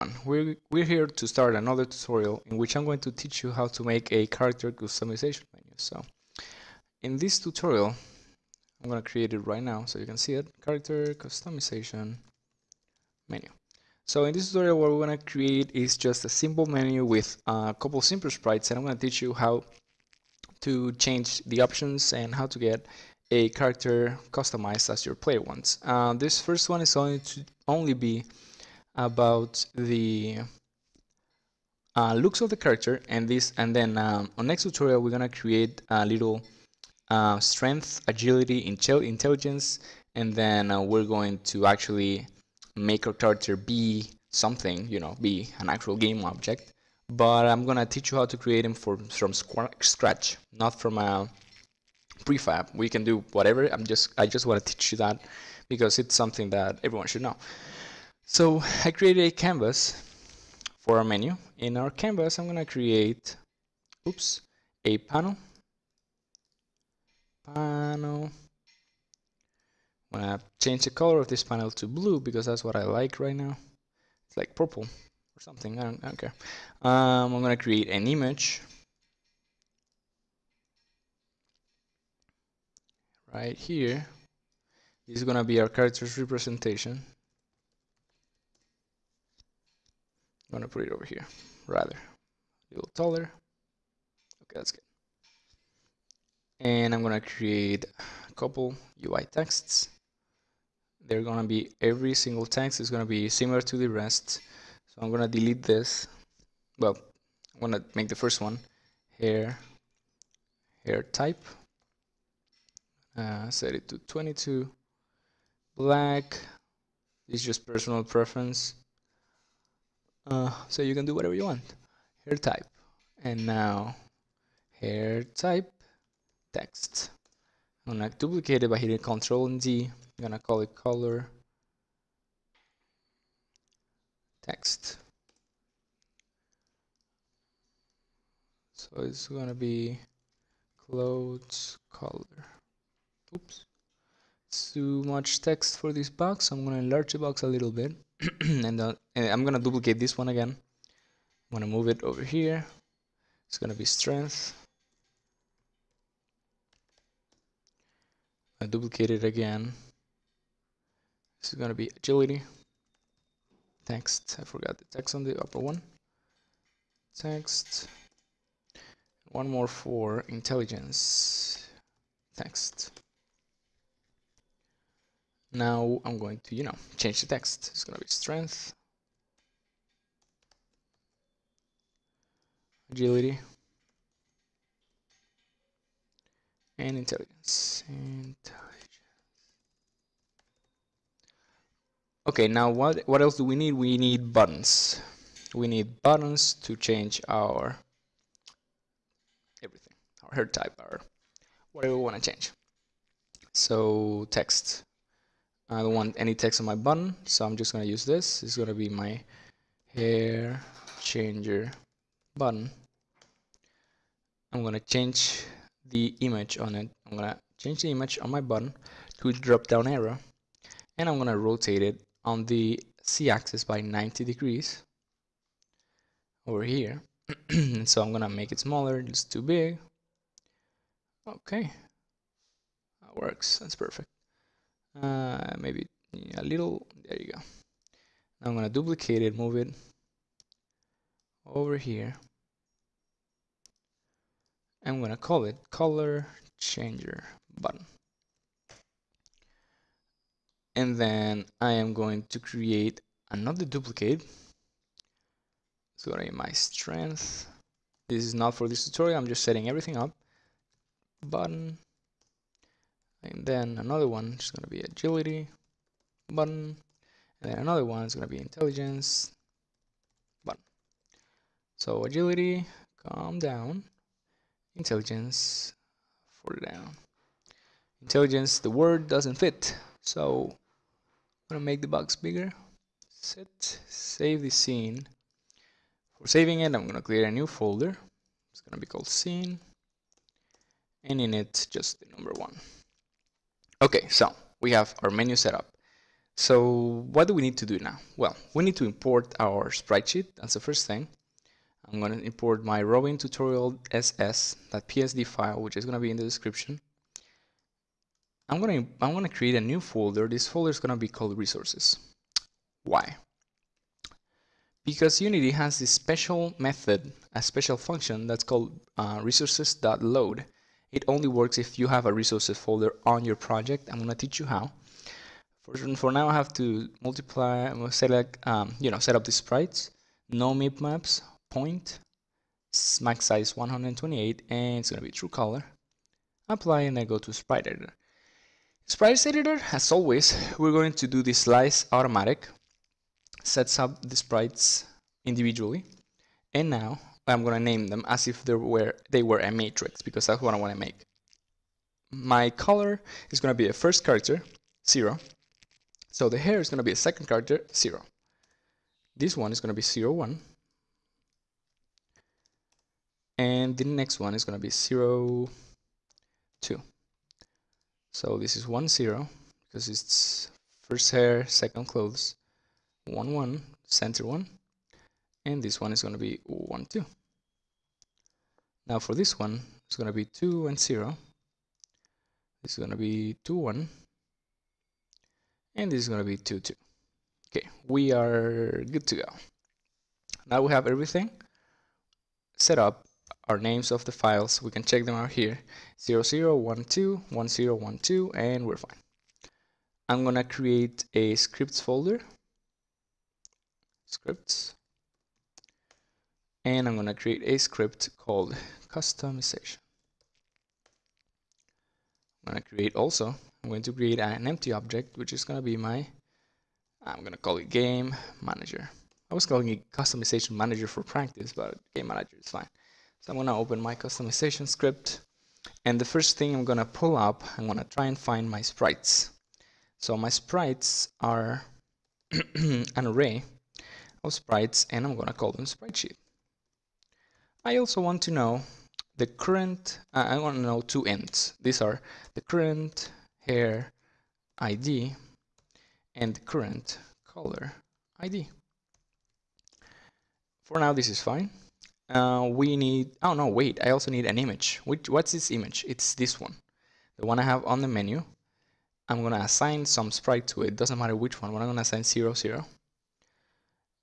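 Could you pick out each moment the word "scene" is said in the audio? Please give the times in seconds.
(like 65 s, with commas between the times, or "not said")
284 s, 289 s.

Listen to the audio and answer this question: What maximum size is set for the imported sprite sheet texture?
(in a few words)
128.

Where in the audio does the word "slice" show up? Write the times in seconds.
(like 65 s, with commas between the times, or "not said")
341 s.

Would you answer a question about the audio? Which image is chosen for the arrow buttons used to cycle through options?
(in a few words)
Drop down arrow.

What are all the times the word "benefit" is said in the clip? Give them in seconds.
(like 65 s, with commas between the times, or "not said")
not said.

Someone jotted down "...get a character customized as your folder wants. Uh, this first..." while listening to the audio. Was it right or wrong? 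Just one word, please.
wrong.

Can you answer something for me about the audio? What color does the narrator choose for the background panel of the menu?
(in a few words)
Blue.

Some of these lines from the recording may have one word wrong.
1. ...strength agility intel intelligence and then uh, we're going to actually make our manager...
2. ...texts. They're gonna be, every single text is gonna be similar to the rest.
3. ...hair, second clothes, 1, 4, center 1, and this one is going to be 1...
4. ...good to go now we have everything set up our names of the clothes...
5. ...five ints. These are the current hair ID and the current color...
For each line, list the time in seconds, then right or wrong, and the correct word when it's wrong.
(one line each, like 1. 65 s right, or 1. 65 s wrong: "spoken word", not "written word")
1. 37 s wrong: "character", not "manager"
2. 99 s right
3. 371 s wrong: "1", not "4"
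4. 388 s wrong: "files", not "clothes"
5. 440 s wrong: "two", not "five".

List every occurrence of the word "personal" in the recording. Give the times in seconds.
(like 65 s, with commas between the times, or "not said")
117 s.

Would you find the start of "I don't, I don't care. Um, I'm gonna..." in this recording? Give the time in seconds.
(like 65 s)
75 s.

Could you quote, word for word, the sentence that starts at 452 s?
Uh, we need, oh no, wait, I also need an image.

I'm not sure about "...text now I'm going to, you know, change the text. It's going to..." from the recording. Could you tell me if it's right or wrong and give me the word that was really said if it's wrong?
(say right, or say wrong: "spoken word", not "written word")
right.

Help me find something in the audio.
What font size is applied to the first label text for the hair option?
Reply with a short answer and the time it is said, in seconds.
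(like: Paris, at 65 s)
22, at 114 s.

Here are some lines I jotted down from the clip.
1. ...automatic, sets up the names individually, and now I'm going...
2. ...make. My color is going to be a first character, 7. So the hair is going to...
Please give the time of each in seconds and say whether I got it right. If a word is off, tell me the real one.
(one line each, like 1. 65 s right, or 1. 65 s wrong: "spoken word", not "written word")
1. 341 s wrong: "sprites", not "names"
2. 350 s wrong: "0", not "7".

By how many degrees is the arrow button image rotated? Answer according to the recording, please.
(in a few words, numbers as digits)
90.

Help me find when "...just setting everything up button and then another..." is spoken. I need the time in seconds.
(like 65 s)
259 s.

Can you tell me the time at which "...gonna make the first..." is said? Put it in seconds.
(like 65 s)
107 s.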